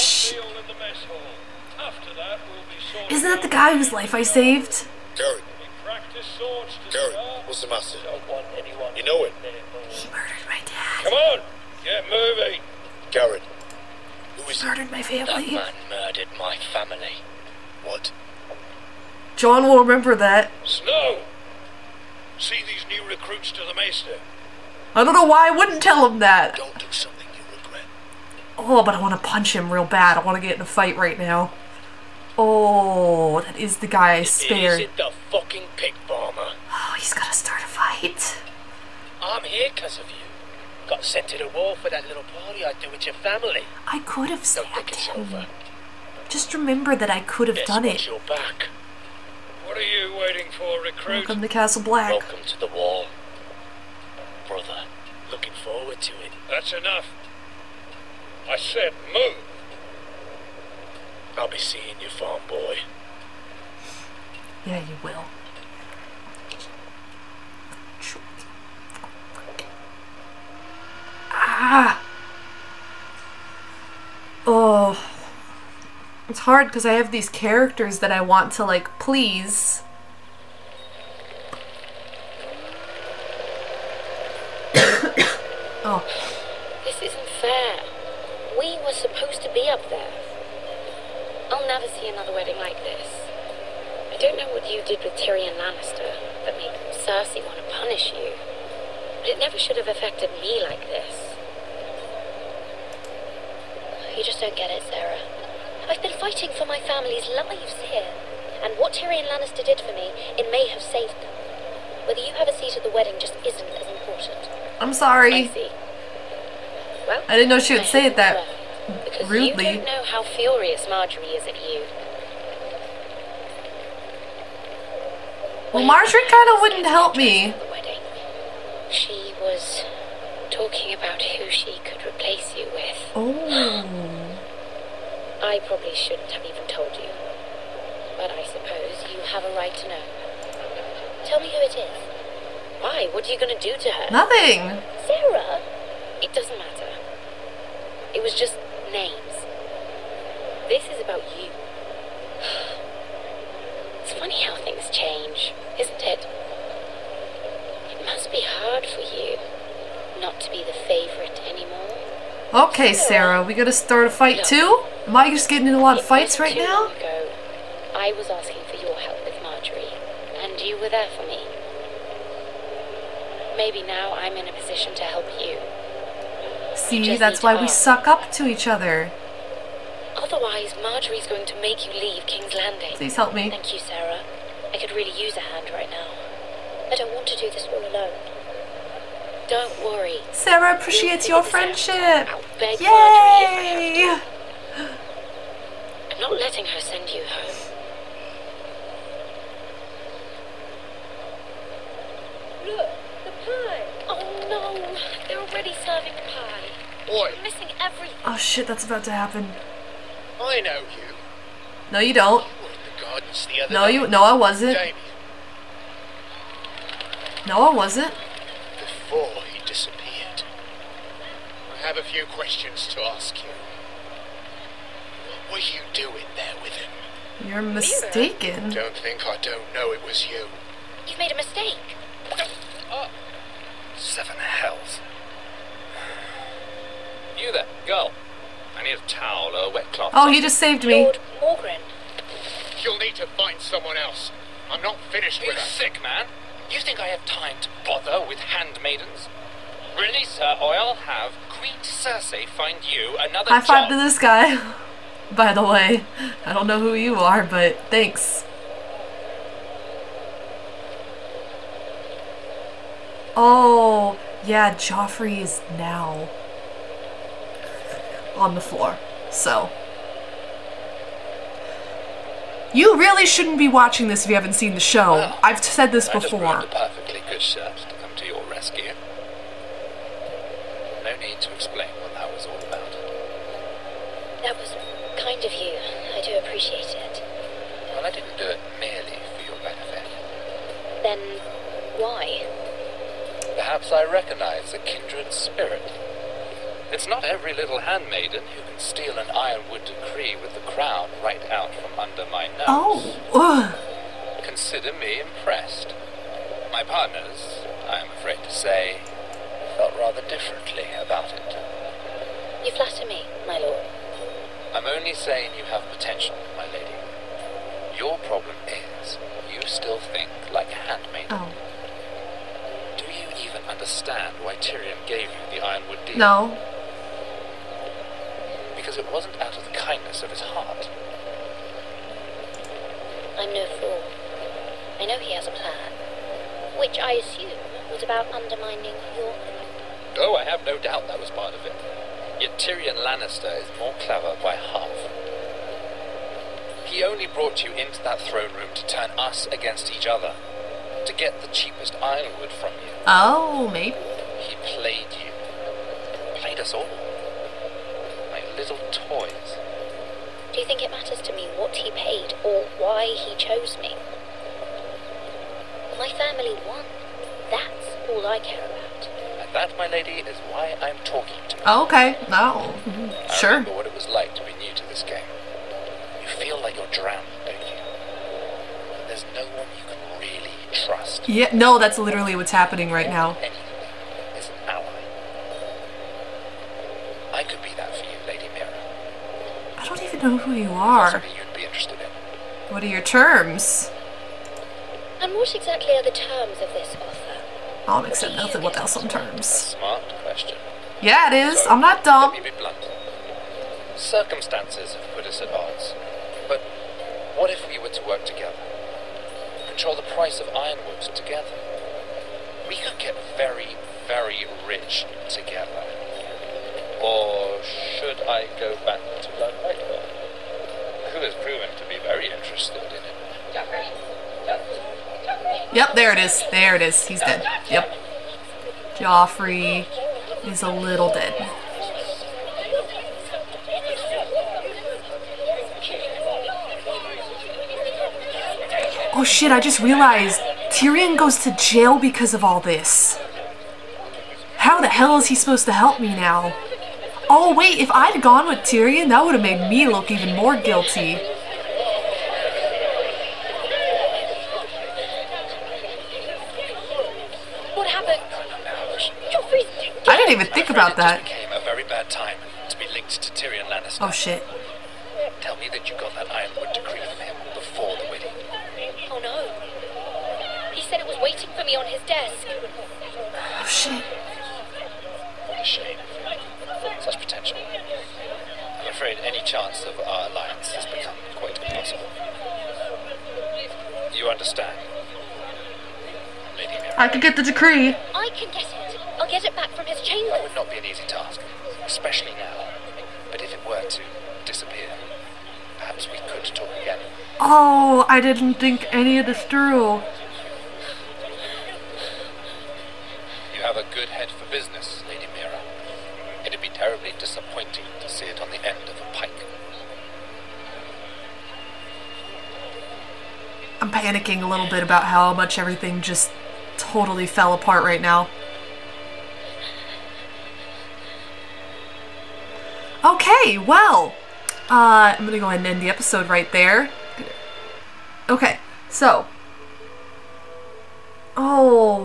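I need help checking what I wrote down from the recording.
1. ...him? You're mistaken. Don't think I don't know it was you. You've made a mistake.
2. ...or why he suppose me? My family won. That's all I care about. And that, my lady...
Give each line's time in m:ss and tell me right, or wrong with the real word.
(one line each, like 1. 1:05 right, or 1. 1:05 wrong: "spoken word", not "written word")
1. 3:46 right
2. 6:02 wrong: "chose", not "suppose".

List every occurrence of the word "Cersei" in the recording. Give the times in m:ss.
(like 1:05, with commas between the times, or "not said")
1:36, 4:11.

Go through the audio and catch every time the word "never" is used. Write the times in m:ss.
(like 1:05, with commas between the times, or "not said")
1:31, 1:39.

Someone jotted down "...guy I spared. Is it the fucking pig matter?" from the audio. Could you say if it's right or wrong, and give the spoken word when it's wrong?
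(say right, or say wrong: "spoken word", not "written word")
wrong: "bomber", not "matter".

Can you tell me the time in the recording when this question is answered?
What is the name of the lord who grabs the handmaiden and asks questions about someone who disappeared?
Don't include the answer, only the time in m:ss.
4:01.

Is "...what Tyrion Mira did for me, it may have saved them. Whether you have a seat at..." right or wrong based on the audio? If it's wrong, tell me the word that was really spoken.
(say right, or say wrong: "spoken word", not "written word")
wrong: "Lannister", not "Mira".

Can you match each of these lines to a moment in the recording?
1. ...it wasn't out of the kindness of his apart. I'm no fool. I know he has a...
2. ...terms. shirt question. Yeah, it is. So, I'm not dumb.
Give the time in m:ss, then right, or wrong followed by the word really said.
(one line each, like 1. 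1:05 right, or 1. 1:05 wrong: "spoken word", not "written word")
1. 5:29 wrong: "heart", not "apart"
2. 6:39 wrong: "smart", not "shirt".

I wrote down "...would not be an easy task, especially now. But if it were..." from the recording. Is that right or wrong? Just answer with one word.
right.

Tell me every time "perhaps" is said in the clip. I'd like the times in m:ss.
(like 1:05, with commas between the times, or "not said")
4:53, 8:15.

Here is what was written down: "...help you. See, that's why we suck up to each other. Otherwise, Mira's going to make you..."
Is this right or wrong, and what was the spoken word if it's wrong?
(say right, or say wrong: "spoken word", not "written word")
wrong: "Margaery", not "Mira".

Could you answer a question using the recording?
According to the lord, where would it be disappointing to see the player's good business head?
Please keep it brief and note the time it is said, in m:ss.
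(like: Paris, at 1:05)
on the end of a pike, at 8:28.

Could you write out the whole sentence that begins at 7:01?
who has proven to be very interested in it.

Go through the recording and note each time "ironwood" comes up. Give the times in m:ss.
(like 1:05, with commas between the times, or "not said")
4:59, 5:25, 5:52, 6:50, 7:46.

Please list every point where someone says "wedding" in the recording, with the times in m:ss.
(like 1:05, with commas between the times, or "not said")
1:32, 1:52, 7:48.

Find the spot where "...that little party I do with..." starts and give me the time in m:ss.
0:41.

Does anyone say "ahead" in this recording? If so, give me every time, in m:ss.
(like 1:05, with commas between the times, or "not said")
8:45.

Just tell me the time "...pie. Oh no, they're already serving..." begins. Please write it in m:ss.
3:23.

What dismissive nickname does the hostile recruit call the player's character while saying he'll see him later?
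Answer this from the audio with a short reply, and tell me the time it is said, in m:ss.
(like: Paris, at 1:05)
farm boy, at 1:02.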